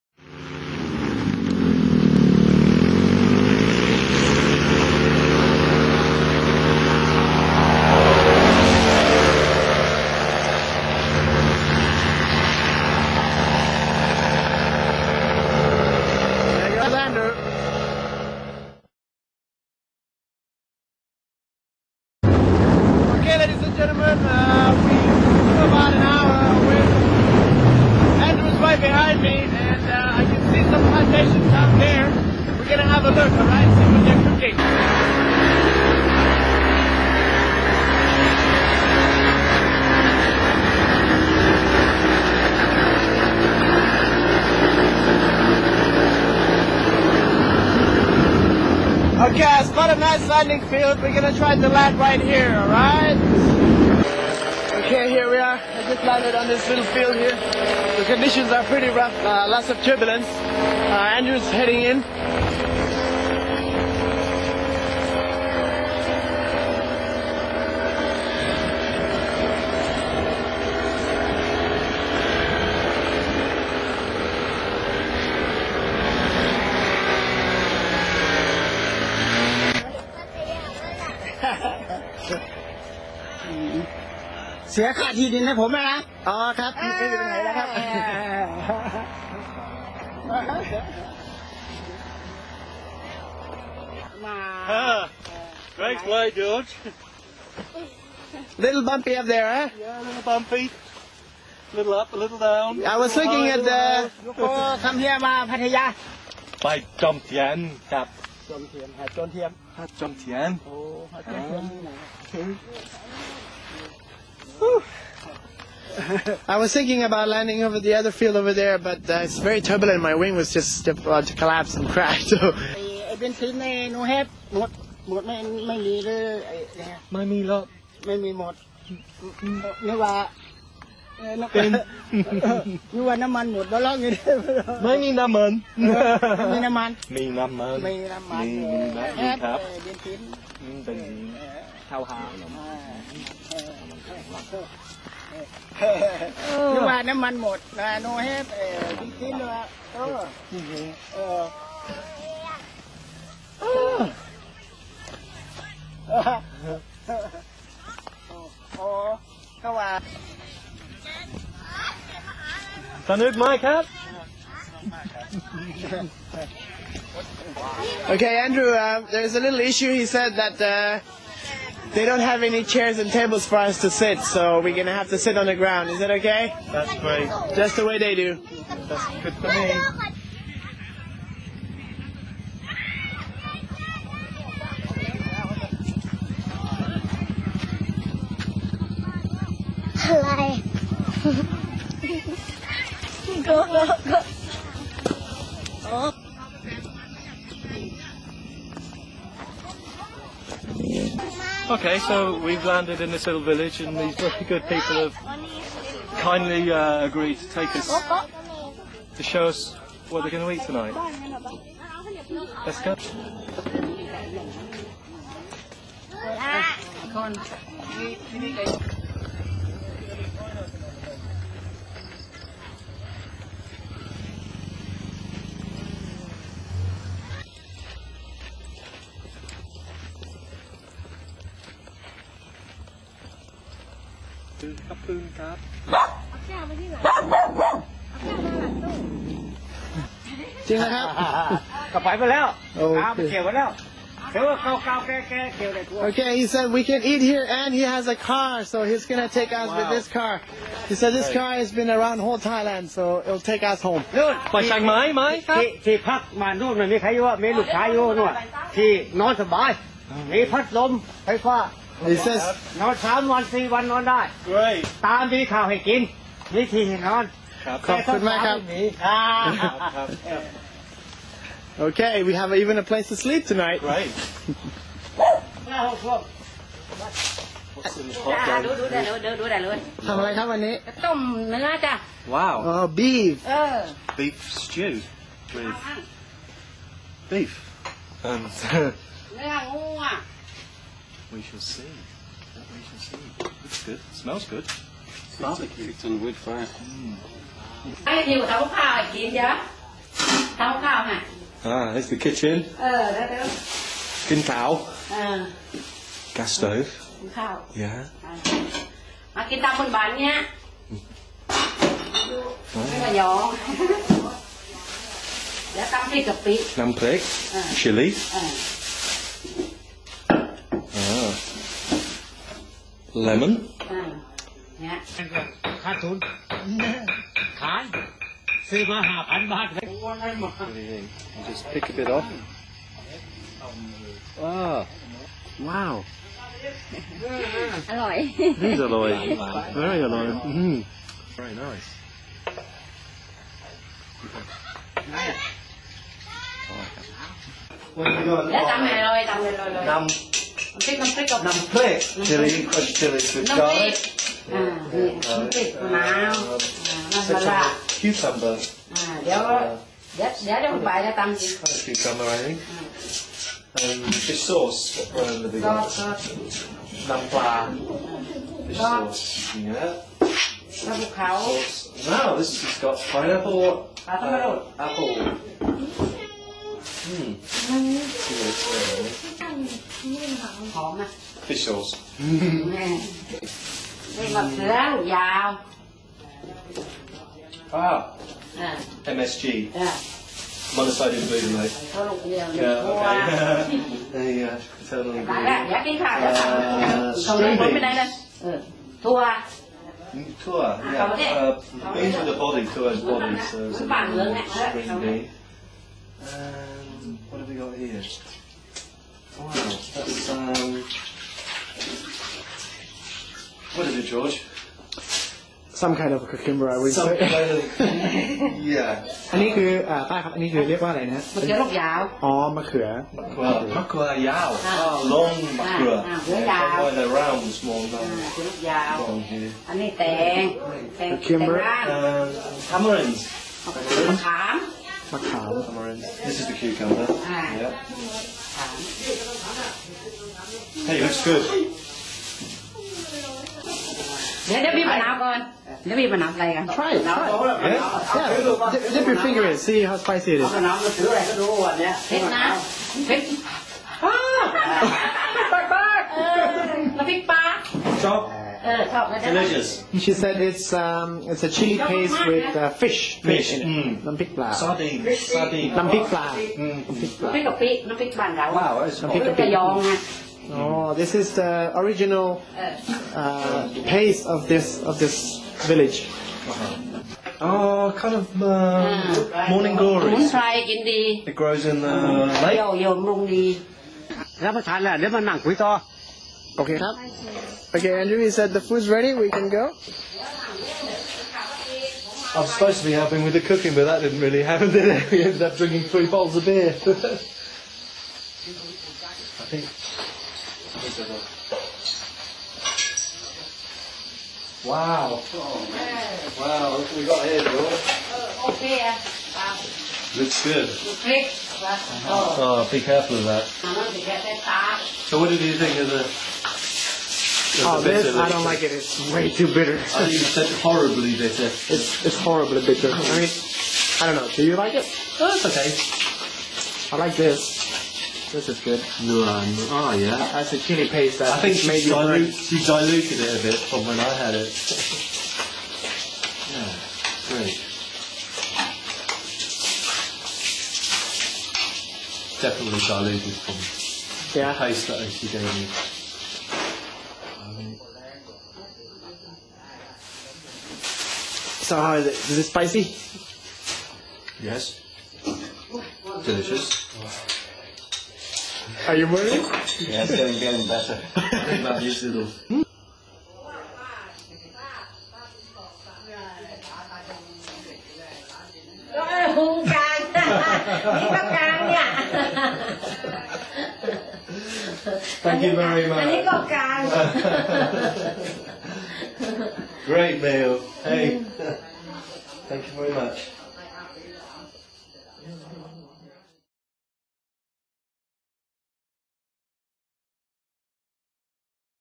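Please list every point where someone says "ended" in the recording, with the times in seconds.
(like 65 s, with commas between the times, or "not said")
495 s.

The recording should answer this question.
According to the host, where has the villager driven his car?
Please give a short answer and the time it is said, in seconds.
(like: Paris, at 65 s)
whole Thailand, at 252 s.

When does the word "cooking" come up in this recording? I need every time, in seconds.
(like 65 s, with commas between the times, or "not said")
34 s, 493 s.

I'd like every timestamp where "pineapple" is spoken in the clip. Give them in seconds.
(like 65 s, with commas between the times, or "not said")
373 s.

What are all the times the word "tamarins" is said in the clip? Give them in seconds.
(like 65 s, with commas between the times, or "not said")
432 s.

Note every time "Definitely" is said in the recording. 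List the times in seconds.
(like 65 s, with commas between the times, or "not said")
542 s.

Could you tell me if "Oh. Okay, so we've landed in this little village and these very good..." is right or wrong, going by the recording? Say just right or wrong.
right.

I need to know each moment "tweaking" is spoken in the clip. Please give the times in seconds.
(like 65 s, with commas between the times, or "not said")
not said.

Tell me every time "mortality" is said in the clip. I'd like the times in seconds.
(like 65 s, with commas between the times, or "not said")
not said.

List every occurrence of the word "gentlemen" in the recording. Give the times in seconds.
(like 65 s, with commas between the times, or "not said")
23 s.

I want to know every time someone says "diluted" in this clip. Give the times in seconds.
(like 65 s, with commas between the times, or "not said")
532 s, 542 s.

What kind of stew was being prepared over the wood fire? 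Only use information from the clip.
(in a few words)
Beef stew.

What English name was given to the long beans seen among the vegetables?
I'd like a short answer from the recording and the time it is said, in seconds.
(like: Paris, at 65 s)
string bean, at 404 s.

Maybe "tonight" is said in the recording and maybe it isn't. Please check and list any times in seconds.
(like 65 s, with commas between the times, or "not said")
210 s, 273 s.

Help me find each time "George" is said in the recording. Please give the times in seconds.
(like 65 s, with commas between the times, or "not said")
96 s, 414 s.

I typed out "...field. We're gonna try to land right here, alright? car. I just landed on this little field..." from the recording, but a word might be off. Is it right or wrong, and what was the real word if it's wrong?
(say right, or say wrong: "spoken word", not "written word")
right.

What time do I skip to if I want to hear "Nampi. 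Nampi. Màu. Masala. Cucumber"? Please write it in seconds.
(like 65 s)
354 s.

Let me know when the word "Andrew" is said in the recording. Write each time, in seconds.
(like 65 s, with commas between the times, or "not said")
28 s, 61 s, 168 s, 488 s.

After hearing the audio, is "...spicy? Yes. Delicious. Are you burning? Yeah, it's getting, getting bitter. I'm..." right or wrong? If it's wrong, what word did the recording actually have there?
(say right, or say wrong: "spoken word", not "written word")
wrong: "better", not "bitter".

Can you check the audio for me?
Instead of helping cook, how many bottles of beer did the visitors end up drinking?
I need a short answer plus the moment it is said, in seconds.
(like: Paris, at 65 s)
3, at 495 s.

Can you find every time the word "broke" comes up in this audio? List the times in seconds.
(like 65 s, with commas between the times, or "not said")
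not said.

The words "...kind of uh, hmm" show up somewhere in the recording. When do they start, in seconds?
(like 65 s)
478 s.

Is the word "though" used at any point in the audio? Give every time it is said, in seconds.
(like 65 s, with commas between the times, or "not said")
not said.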